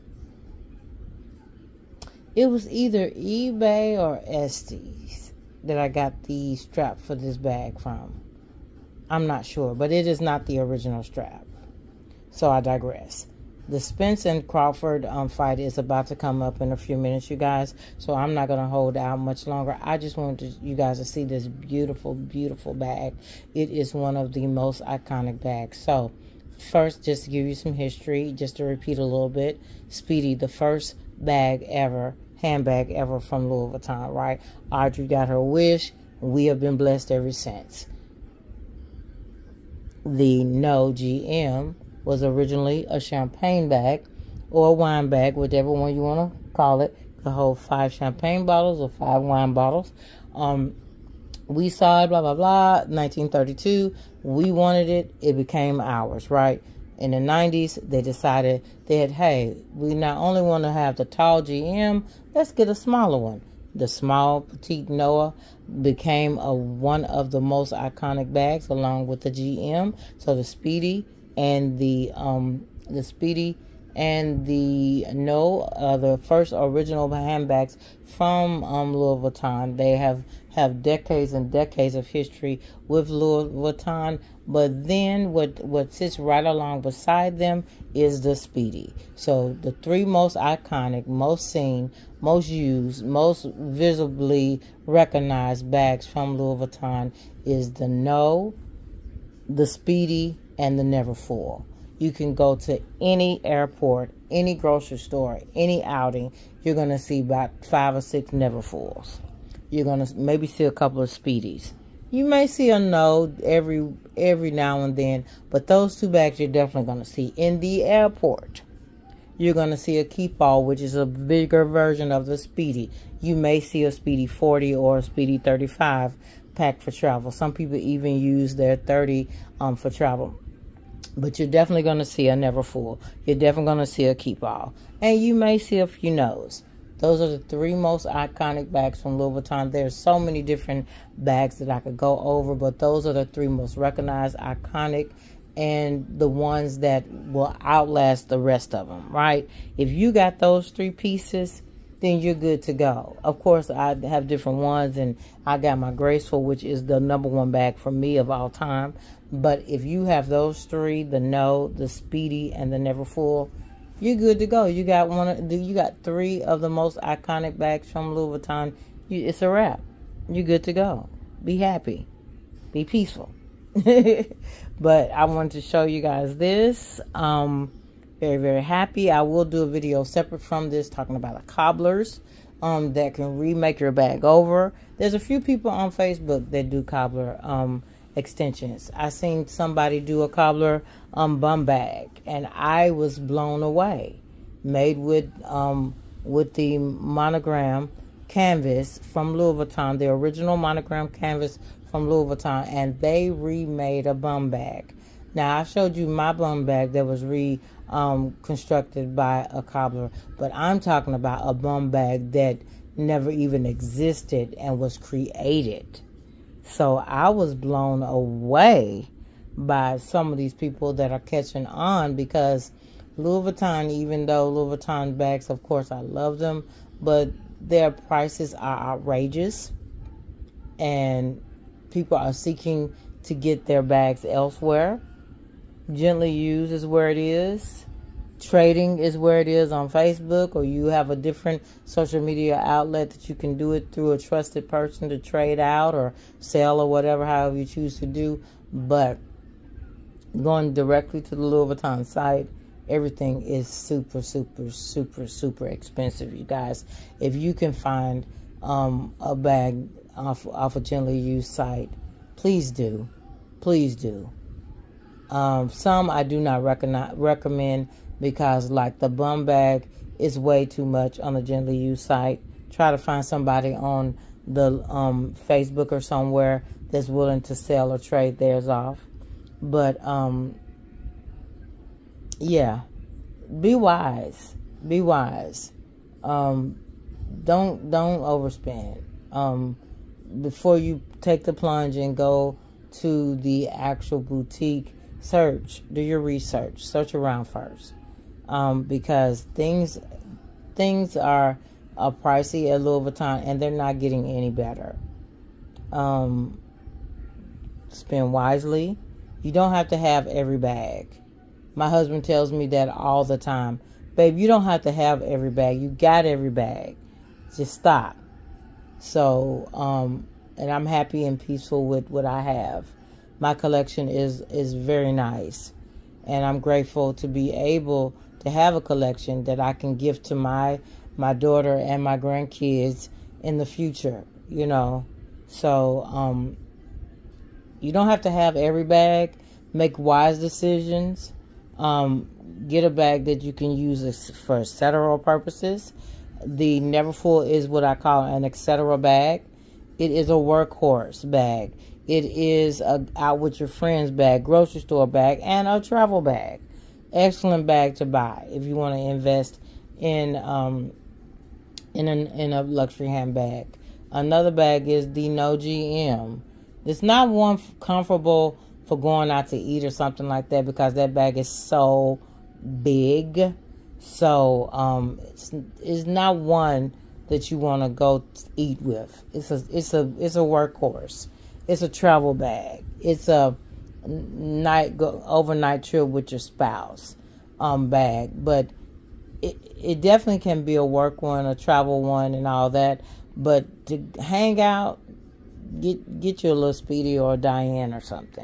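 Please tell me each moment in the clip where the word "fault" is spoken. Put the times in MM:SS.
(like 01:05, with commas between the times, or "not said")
not said.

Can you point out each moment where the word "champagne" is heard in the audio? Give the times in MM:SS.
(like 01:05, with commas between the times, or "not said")
00:42, 00:47.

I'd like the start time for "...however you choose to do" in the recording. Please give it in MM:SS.
04:07.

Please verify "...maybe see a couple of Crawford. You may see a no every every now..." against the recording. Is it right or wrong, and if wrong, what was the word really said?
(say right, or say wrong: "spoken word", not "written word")
wrong: "Speedies", not "Crawford".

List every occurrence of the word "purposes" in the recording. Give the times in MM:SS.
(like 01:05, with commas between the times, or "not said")
05:45.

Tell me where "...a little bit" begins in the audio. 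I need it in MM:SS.
00:28.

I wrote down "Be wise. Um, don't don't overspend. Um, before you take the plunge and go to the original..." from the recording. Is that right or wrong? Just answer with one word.
wrong.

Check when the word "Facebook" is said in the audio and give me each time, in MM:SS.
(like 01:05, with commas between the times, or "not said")
03:05, 03:59, 04:35.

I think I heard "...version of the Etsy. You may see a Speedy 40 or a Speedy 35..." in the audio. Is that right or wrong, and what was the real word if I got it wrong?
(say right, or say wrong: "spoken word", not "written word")
wrong: "Speedy", not "Etsy".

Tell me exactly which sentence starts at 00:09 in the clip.
I'm not sure, but it is not the original strap.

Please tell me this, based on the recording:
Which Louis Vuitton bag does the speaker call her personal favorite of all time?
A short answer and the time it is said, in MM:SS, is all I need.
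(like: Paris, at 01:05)
Graceful, at 02:35.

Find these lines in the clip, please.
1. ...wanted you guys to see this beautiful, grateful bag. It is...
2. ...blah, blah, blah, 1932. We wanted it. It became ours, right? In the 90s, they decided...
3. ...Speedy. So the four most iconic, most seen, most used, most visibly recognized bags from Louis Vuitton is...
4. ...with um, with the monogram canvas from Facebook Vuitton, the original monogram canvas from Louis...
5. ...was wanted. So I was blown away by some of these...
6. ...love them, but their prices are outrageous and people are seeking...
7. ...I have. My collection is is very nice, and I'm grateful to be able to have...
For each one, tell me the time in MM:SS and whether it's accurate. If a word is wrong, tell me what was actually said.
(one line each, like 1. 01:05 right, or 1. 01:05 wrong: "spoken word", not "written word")
1. 00:20 wrong: "beautiful", not "grateful"
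2. 00:52 right
3. 01:28 wrong: "three", not "four"
4. 03:14 wrong: "Louis", not "Facebook"
5. 03:34 wrong: "created", not "wanted"
6. 03:46 right
7. 05:22 right.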